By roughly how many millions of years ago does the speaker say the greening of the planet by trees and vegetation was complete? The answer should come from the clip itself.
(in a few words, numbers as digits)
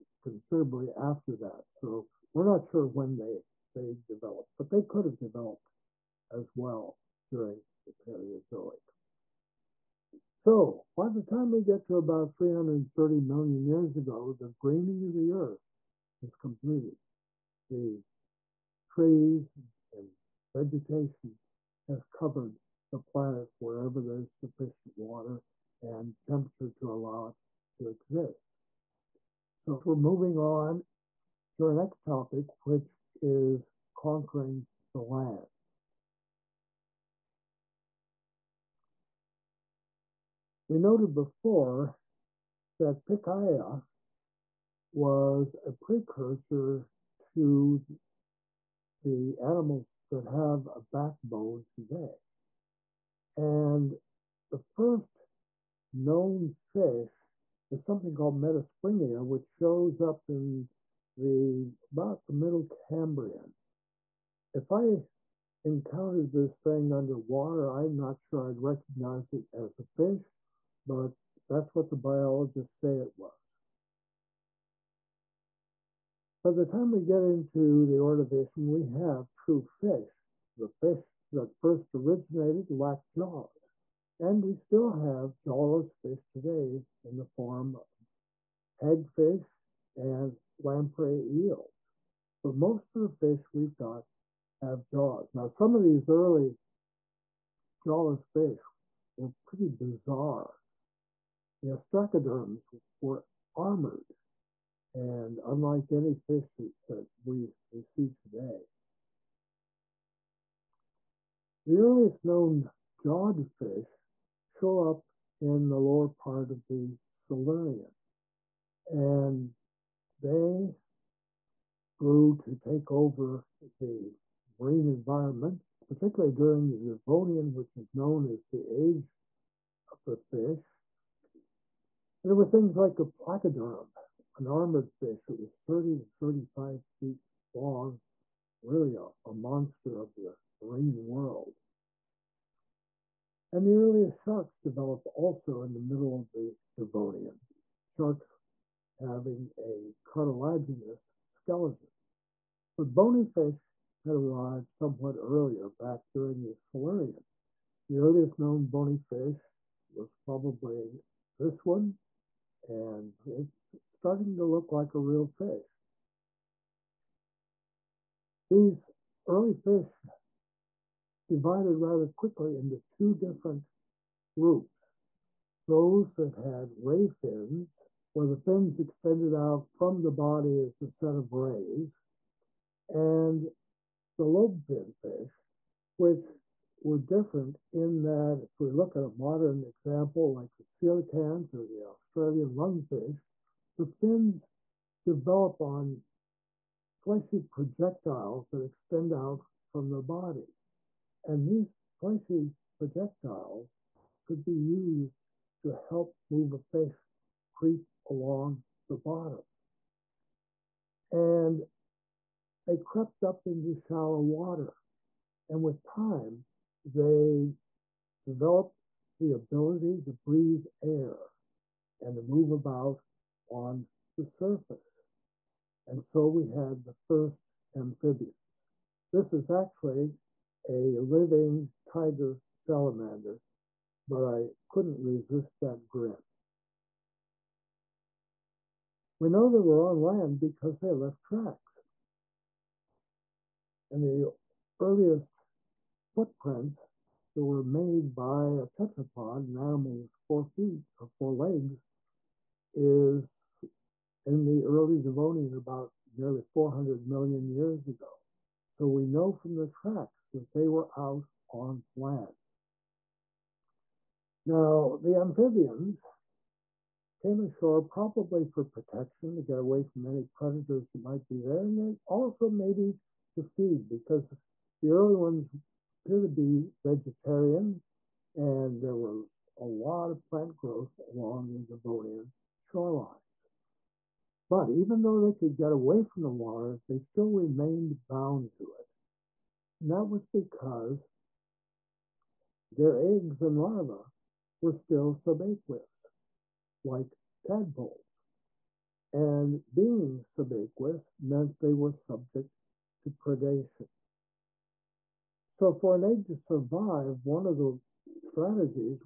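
330 million years ago.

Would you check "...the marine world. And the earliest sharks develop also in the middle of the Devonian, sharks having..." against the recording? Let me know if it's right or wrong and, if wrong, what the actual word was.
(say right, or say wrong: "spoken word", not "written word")
right.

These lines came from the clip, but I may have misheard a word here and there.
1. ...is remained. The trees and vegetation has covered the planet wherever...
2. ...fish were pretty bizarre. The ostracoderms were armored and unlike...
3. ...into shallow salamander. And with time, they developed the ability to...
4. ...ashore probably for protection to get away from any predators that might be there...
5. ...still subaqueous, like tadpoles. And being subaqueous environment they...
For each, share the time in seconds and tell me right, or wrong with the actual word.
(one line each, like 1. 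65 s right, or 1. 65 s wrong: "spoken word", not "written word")
1. 16 s wrong: "completed", not "remained"
2. 98 s right
3. 213 s wrong: "water", not "salamander"
4. 267 s right
5. 294 s wrong: "meant", not "environment".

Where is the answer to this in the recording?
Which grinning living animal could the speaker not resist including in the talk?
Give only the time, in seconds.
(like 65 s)
231 s.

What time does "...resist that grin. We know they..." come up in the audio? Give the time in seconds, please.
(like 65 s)
235 s.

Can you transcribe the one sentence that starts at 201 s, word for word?
And these fleshy projectiles could be used to help move a fish creep along the bottom.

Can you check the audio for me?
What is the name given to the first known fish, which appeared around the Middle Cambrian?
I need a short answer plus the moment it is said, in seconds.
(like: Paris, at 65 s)
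Metaspriggina, at 58 s.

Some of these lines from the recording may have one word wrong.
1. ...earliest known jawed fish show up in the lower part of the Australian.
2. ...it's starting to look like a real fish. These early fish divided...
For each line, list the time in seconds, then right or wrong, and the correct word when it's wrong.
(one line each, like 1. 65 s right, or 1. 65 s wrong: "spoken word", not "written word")
1. 111 s wrong: "Silurian", not "Australian"
2. 163 s right.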